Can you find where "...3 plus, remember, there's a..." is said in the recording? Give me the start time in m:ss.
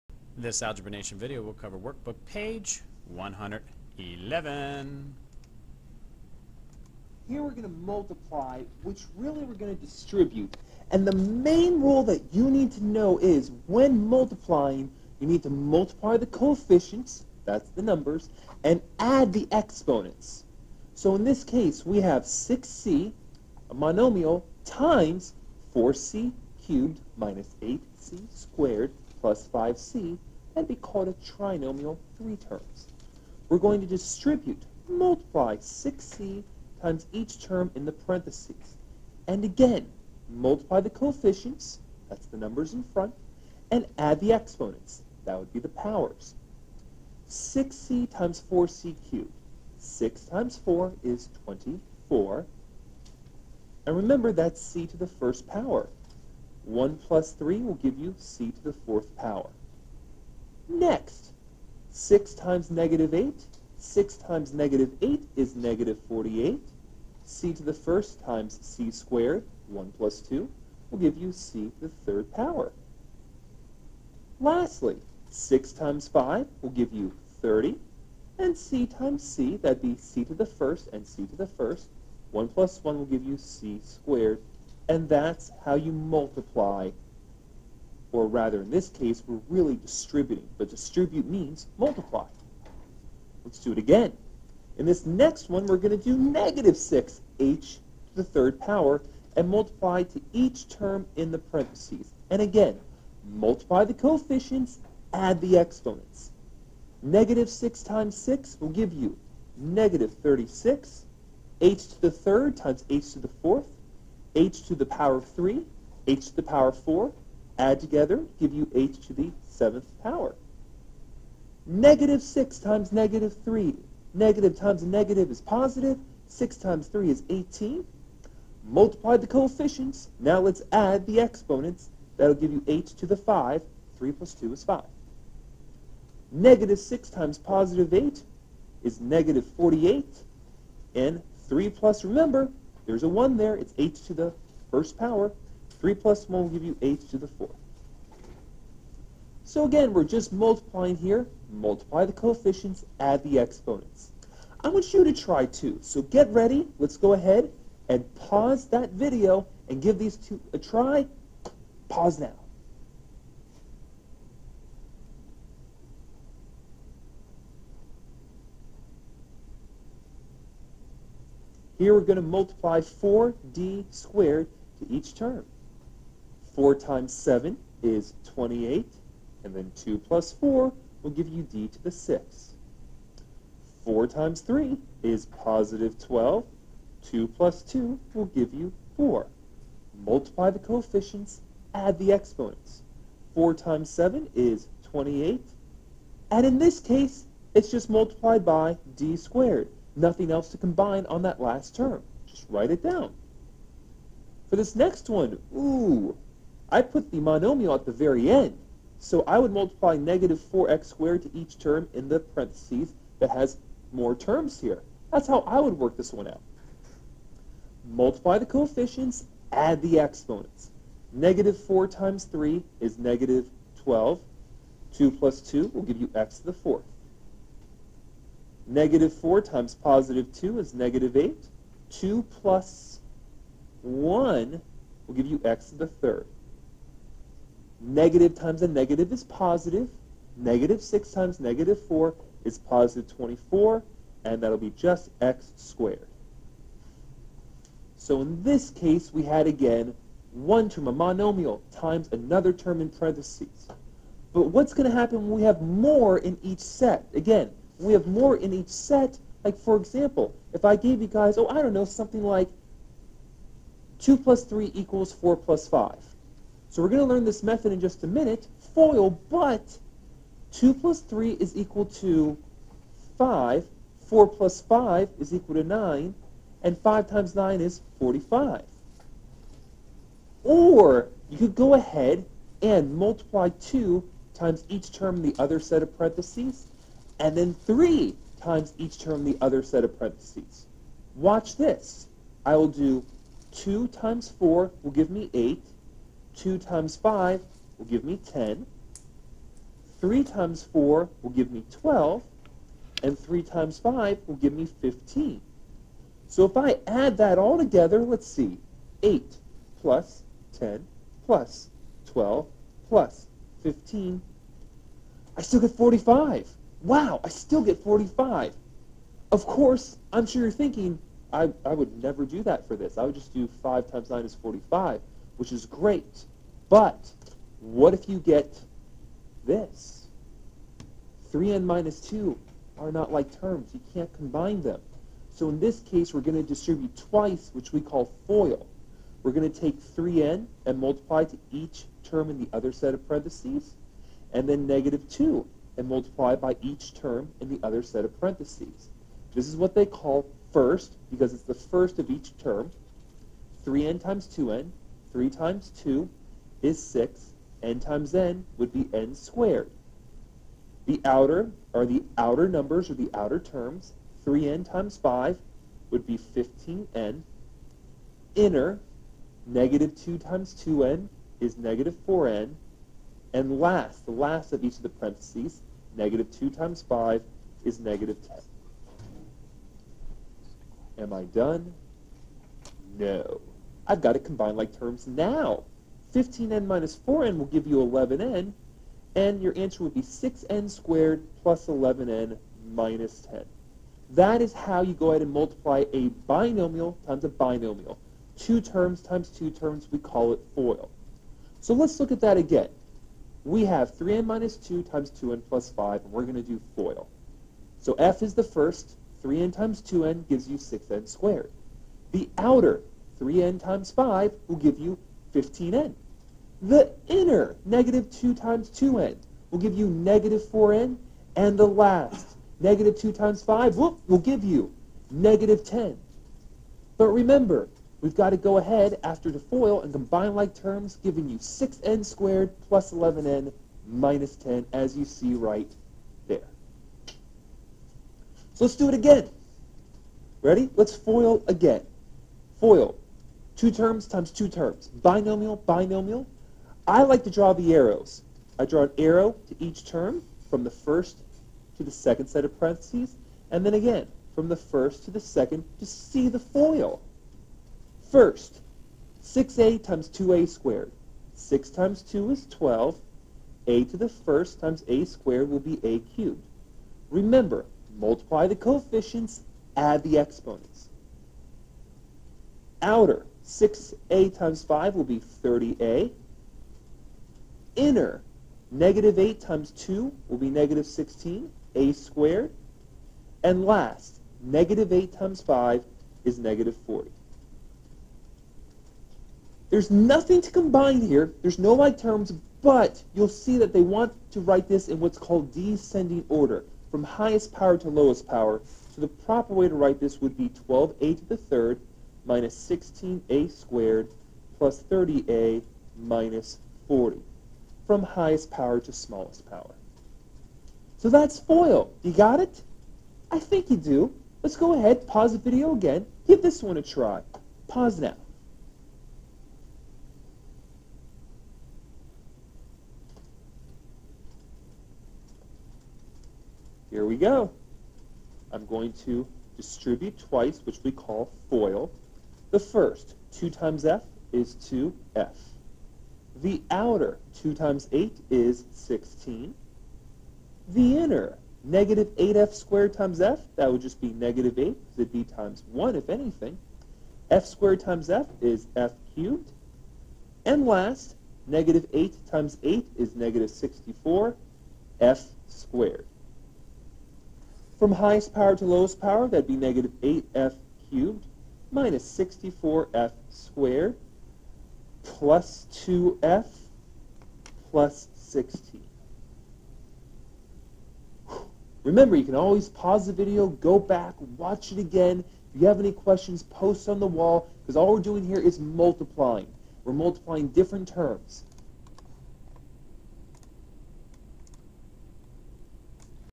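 2:21.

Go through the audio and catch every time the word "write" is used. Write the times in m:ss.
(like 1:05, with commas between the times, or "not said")
3:22, 8:14, 8:19.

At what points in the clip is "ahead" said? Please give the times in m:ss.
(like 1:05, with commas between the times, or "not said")
2:37, 4:41, 6:35, 7:08, 8:34.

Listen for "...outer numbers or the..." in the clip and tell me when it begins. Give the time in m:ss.
6:02.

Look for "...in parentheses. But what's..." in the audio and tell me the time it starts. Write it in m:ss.
4:12.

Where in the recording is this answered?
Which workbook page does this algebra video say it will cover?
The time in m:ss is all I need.
0:03.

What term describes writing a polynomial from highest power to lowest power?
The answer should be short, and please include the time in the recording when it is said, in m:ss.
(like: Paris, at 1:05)
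descending order, at 8:15.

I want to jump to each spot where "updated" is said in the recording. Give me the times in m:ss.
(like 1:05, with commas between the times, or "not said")
not said.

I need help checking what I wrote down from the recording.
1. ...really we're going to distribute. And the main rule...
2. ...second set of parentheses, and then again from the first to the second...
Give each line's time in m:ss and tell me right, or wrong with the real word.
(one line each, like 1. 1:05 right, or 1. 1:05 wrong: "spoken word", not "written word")
1. 0:09 right
2. 7:31 right.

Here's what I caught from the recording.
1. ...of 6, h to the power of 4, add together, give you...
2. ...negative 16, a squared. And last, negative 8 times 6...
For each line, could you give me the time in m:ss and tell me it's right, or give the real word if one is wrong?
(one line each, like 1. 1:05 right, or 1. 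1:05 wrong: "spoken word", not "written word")
1. 1:55 wrong: "3", not "6"
2. 8:00 wrong: "5", not "6".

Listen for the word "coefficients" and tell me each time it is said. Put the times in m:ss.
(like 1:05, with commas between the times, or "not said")
0:16, 0:40, 1:43, 2:09, 2:32, 3:10, 3:38, 7:48.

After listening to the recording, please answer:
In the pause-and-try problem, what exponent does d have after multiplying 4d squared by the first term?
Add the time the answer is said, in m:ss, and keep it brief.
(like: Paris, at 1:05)
6, at 3:01.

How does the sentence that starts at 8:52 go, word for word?
The first, 2 times f, is 2f.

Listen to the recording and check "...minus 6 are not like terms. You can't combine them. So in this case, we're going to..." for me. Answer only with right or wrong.
wrong.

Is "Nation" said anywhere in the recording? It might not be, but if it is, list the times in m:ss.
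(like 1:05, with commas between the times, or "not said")
0:00.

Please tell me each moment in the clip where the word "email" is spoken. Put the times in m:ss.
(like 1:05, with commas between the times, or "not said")
not said.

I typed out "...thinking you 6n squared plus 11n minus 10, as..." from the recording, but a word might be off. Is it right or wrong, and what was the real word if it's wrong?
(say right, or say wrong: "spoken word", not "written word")
wrong: "giving", not "thinking".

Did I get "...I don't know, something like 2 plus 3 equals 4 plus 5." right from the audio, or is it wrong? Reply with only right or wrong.
right.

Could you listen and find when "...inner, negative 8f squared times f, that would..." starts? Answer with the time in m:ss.
9:00.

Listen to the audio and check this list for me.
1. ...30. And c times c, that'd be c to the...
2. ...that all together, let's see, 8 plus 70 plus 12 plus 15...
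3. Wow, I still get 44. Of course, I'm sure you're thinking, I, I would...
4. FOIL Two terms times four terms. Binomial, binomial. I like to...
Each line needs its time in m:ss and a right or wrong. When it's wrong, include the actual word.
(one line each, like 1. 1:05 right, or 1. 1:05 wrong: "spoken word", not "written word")
1. 1:17 right
2. 5:07 wrong: "10", not "70"
3. 5:16 wrong: "45", not "44"
4. 7:22 wrong: "two", not "four".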